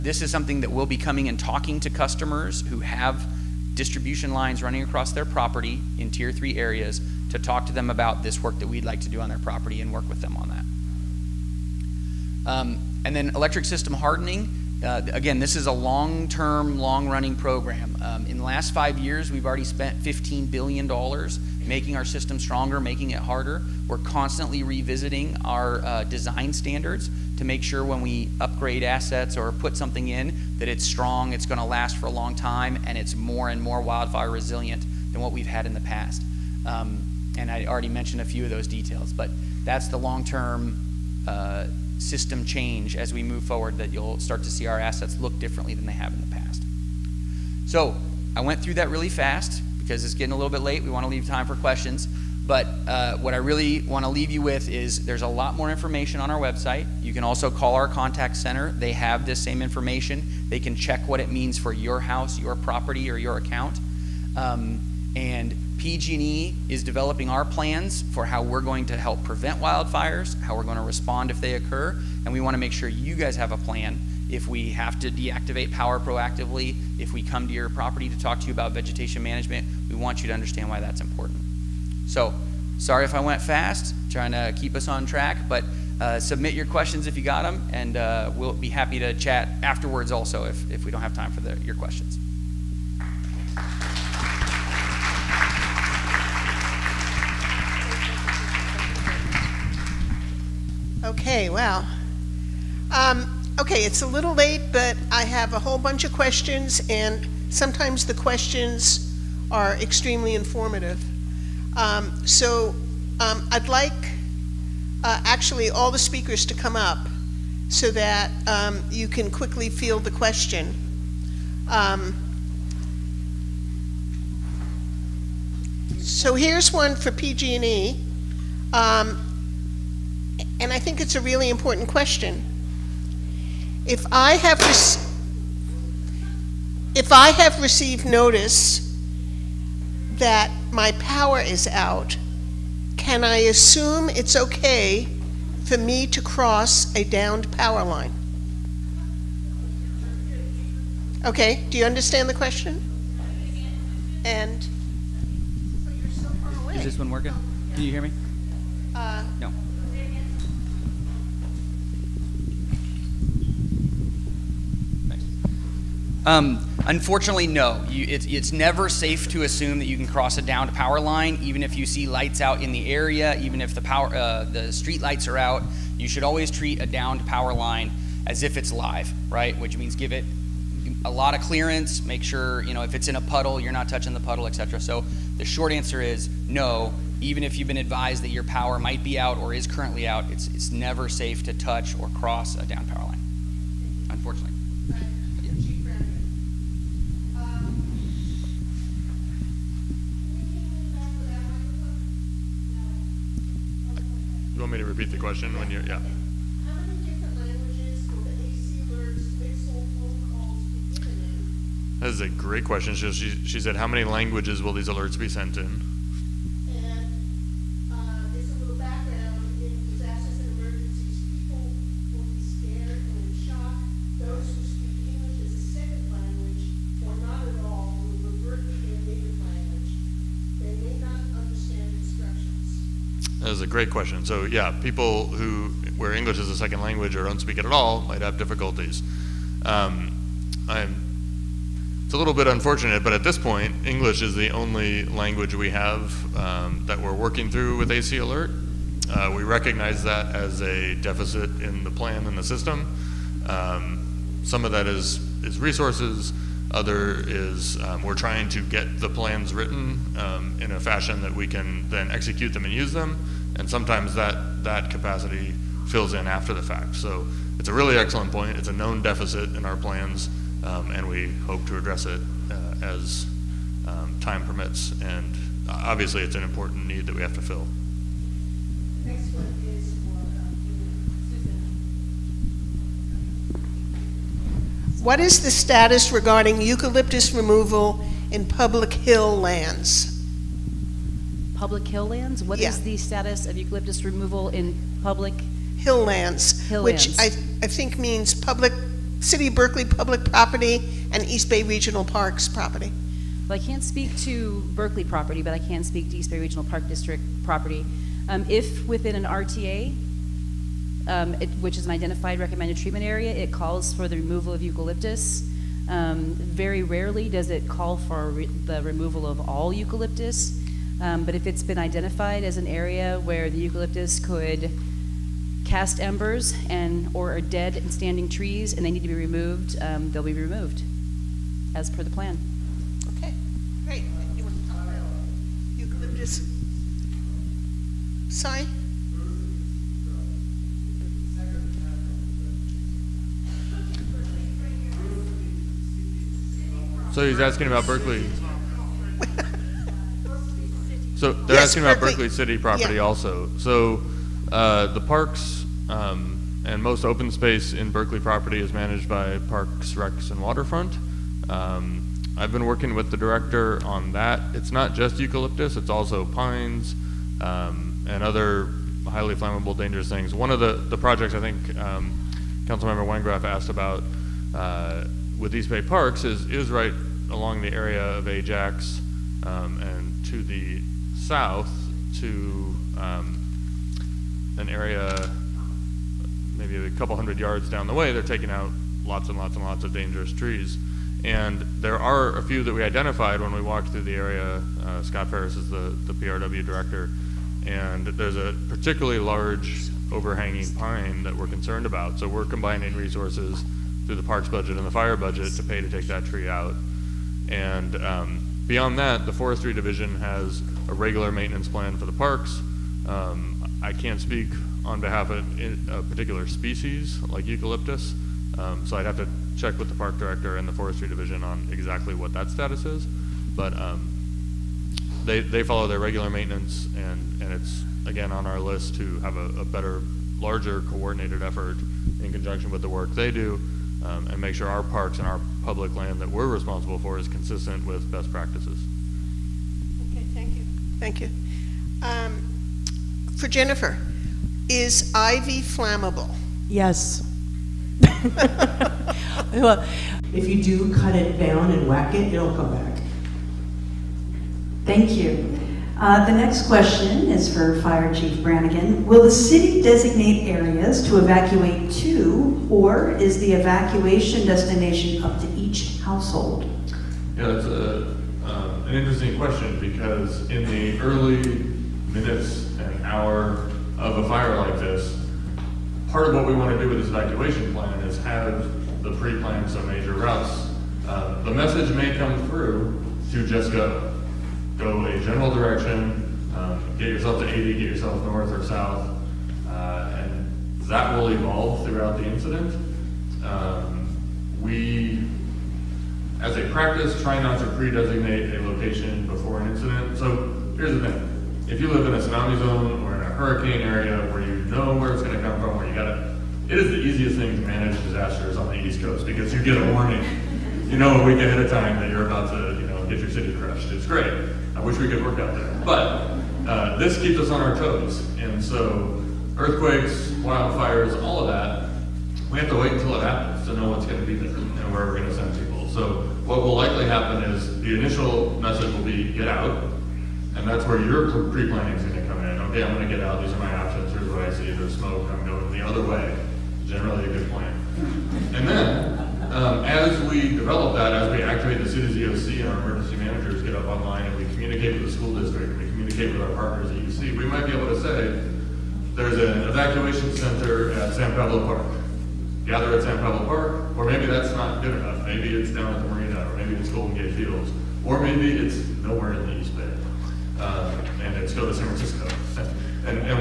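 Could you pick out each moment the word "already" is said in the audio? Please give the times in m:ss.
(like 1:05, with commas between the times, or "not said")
0:19, 0:37.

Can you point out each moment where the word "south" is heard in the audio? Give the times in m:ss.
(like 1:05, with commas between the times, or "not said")
6:21, 8:08.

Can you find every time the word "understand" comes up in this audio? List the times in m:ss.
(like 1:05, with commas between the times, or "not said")
1:20, 2:31.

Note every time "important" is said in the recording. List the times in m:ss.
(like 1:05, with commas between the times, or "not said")
1:21, 2:11, 4:36.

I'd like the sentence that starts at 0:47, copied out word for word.
So I went through that really fast because it's getting a little bit late.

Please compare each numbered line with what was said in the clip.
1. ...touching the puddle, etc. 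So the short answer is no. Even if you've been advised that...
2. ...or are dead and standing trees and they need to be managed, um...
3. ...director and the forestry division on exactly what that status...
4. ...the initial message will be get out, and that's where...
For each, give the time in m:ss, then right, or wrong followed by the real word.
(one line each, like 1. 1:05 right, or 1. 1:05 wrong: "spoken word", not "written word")
1. 3:03 right
2. 5:27 wrong: "removed", not "managed"
3. 7:00 right
4. 8:47 right.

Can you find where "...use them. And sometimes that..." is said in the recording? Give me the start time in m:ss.
4:22.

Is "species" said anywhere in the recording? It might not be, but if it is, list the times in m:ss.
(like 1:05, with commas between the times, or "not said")
6:56.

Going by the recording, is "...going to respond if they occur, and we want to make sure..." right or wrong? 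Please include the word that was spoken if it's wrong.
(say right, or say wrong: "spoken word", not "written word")
right.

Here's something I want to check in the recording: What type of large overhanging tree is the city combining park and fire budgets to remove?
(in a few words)
Pine.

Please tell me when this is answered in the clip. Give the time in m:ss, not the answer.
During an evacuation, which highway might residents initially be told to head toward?
8:07.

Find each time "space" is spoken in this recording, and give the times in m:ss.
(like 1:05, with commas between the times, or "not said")
5:57.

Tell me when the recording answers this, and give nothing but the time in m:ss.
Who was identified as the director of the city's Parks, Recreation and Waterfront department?
6:35.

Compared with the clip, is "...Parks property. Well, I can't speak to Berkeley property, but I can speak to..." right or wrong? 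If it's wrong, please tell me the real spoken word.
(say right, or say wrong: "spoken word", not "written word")
right.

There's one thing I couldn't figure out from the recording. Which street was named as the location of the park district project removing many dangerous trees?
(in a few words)
Ajax.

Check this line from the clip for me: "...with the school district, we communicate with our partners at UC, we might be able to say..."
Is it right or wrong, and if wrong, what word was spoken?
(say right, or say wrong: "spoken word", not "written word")
right.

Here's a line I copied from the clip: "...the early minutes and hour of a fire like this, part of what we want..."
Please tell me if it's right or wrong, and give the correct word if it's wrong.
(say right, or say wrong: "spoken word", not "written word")
right.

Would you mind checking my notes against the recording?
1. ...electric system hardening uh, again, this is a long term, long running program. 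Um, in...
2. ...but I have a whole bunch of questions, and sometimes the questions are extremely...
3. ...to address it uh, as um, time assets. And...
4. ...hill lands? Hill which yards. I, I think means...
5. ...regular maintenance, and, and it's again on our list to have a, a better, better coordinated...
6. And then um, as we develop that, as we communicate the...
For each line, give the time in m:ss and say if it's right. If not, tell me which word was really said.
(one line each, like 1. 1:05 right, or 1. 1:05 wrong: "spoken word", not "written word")
1. 0:13 right
2. 1:44 right
3. 4:31 wrong: "permits", not "assets"
4. 4:55 wrong: "lands", not "yards"
5. 7:05 wrong: "larger", not "better"
6. 8:57 wrong: "activate", not "communicate".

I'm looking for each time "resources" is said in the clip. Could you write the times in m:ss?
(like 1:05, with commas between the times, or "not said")
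4:15, 6:42.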